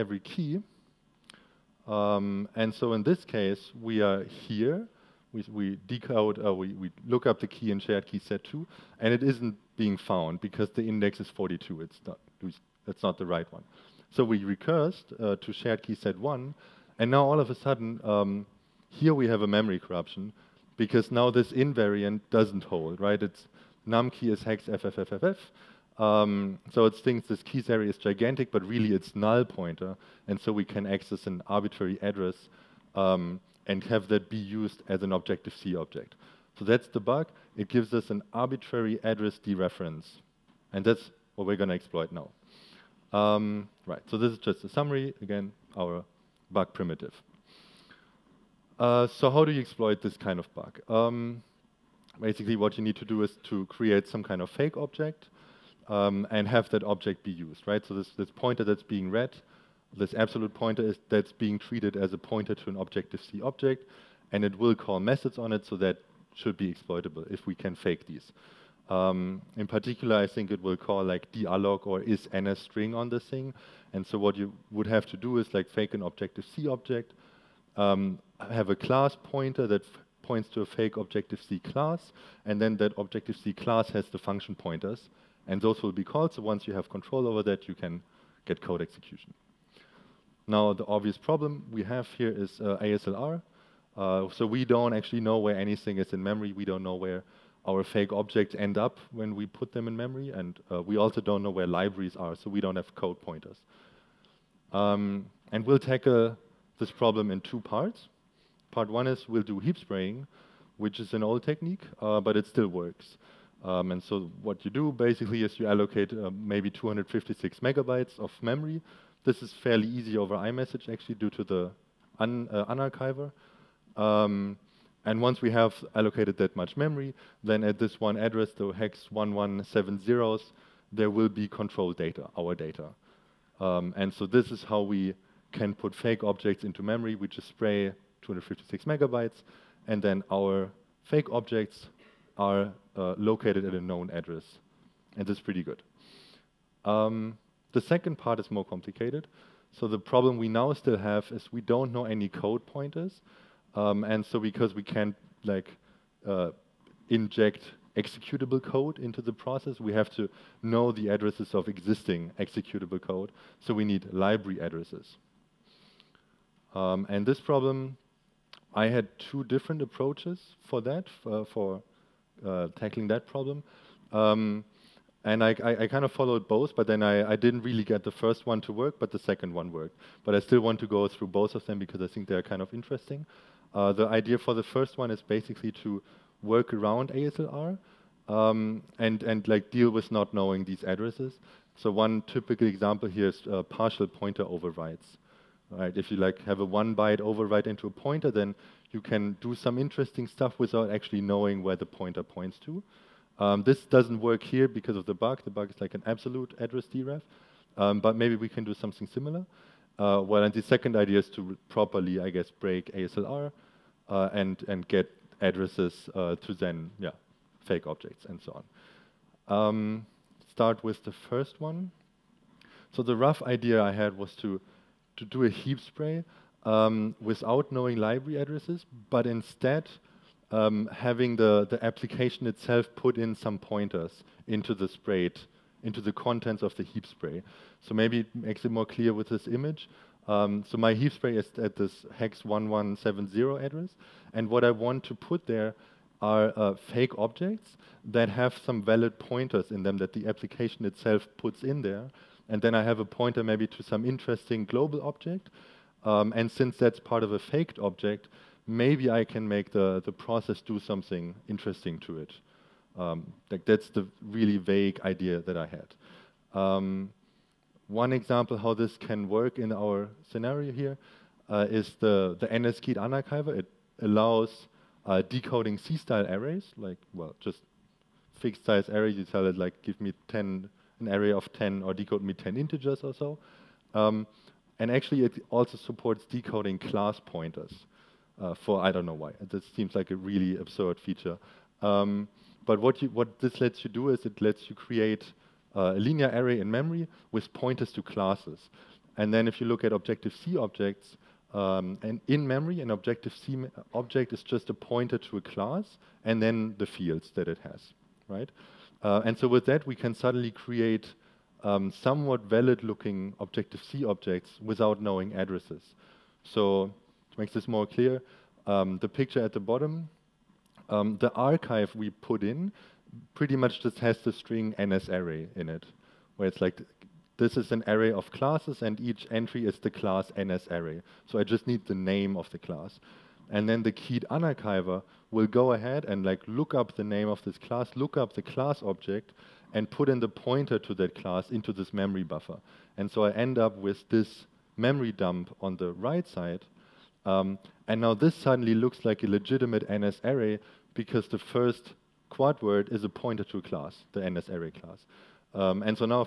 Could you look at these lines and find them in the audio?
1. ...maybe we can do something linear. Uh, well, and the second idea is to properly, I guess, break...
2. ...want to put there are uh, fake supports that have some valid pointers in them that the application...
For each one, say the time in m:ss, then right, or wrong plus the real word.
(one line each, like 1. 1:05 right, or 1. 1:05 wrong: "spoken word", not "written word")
1. 3:28 wrong: "similar", not "linear"
2. 4:04 wrong: "objects", not "supports".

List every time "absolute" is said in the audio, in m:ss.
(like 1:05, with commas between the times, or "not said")
1:00, 3:26.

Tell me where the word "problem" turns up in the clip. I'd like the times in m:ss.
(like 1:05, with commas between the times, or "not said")
1:31, 1:46, 2:29, 2:47, 2:53.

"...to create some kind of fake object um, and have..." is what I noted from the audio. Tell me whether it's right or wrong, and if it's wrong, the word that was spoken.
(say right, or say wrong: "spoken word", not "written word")
right.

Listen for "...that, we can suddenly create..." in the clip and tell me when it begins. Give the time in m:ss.
5:09.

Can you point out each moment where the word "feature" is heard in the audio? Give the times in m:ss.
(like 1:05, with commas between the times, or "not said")
4:50.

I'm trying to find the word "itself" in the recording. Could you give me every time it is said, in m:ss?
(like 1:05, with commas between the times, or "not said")
3:52, 4:10.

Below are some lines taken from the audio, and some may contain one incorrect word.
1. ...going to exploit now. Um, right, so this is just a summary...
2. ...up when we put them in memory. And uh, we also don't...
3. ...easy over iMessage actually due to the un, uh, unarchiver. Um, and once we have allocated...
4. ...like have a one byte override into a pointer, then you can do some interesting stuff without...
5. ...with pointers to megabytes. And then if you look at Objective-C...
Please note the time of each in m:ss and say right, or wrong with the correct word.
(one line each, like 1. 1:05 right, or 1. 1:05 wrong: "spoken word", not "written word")
1. 0:41 right
2. 1:38 right
3. 1:59 right
4. 3:16 right
5. 4:57 wrong: "classes", not "megabytes".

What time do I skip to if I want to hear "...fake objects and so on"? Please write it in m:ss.
3:37.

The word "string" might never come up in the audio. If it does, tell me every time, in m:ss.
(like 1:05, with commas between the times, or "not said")
1:12, 5:24.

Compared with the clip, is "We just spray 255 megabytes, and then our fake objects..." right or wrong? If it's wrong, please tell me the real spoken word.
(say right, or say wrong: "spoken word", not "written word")
wrong: "256", not "255".